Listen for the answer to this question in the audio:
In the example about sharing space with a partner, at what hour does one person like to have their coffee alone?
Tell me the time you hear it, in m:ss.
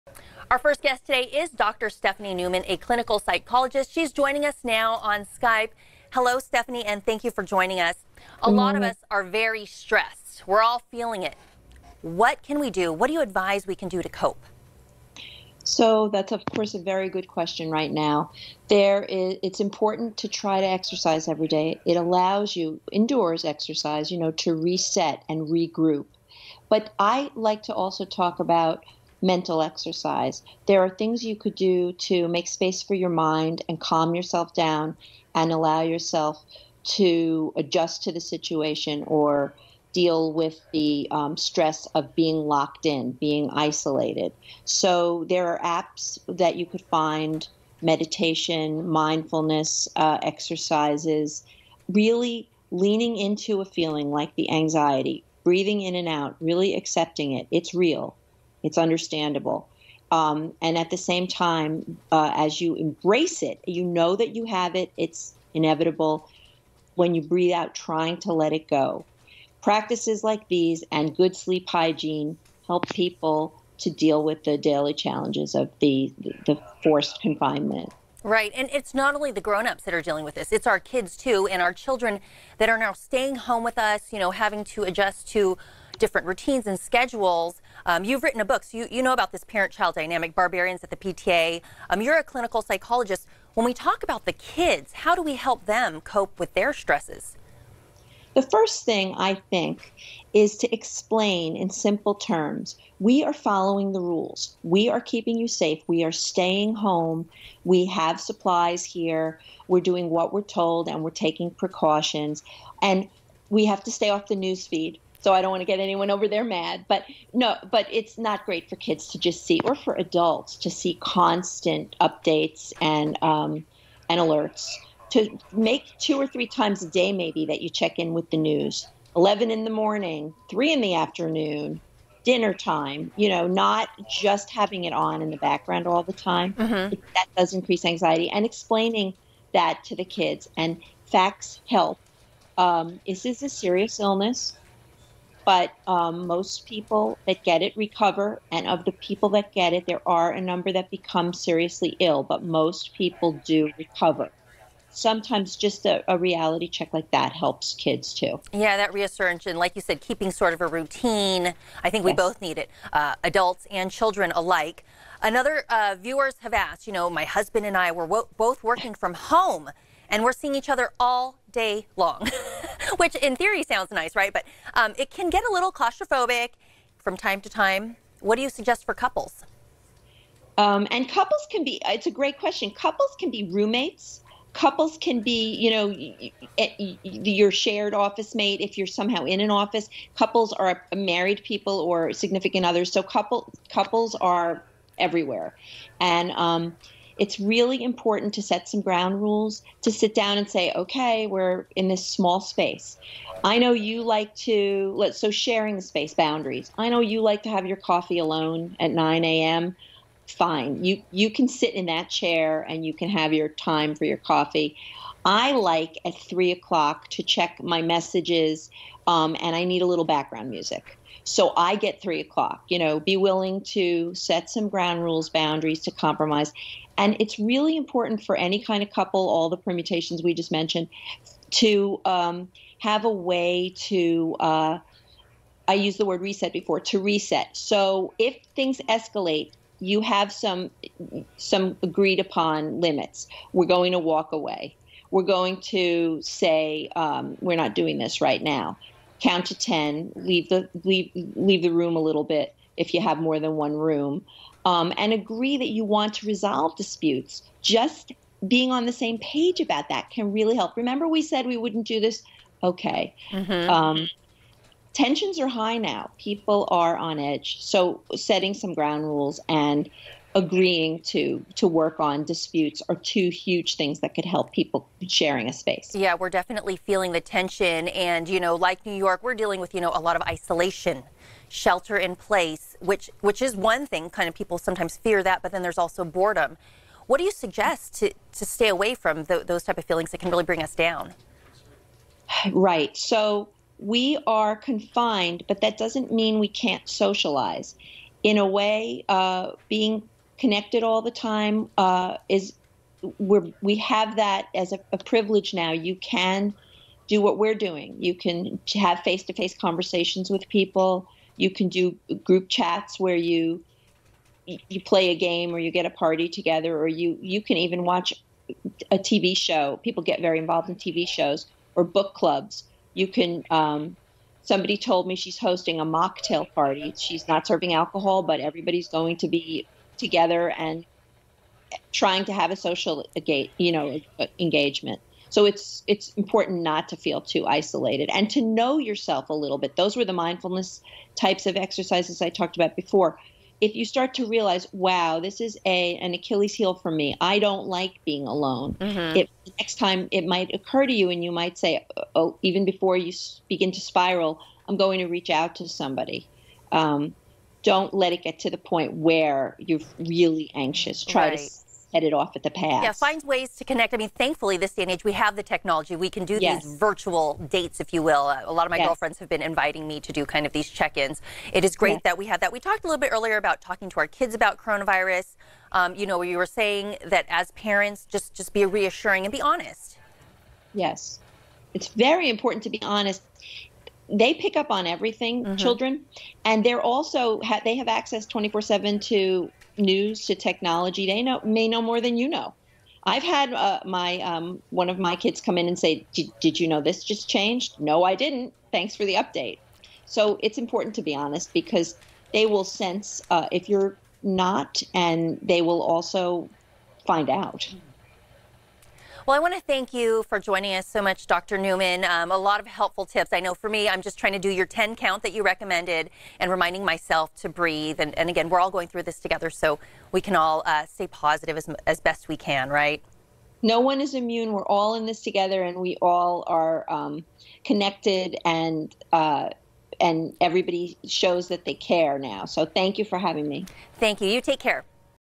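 3:28.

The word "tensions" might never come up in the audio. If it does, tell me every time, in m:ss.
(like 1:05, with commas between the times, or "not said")
4:24, 4:37.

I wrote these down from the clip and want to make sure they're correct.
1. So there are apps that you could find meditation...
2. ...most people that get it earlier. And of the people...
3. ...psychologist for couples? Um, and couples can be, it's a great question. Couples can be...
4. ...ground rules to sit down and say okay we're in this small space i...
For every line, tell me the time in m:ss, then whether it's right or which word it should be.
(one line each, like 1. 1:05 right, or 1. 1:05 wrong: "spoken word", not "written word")
1. 0:44 right
2. 2:26 wrong: "recover", not "earlier"
3. 2:58 wrong: "suggest", not "psychologist"
4. 3:18 right.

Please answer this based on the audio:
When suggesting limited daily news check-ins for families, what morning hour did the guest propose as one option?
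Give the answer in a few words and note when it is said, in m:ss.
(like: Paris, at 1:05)
11 a.m., at 2:09.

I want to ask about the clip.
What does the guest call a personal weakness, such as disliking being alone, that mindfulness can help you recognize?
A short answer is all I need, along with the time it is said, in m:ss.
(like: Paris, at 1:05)
Achilles heel, at 5:46.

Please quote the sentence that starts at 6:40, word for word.
So it's important to be honest because they will sense uh, if you're not, and they will also find out.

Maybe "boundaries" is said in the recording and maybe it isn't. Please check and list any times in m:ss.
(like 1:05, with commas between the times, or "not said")
3:26, 3:45.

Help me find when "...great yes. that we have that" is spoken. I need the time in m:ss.
6:11.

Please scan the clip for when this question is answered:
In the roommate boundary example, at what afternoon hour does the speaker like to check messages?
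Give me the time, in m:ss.
3:36.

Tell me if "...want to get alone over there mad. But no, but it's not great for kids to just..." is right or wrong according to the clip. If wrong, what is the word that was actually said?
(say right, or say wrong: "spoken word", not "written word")
wrong: "anyone", not "alone".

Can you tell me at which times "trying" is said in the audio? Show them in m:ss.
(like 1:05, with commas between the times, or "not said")
1:07, 5:31, 6:54.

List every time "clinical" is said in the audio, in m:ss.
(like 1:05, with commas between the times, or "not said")
0:02, 1:32.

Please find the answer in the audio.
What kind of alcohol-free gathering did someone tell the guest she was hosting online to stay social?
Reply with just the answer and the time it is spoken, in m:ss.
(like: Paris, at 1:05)
A mocktail party, at 5:25.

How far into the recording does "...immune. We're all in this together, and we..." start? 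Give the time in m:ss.
7:04.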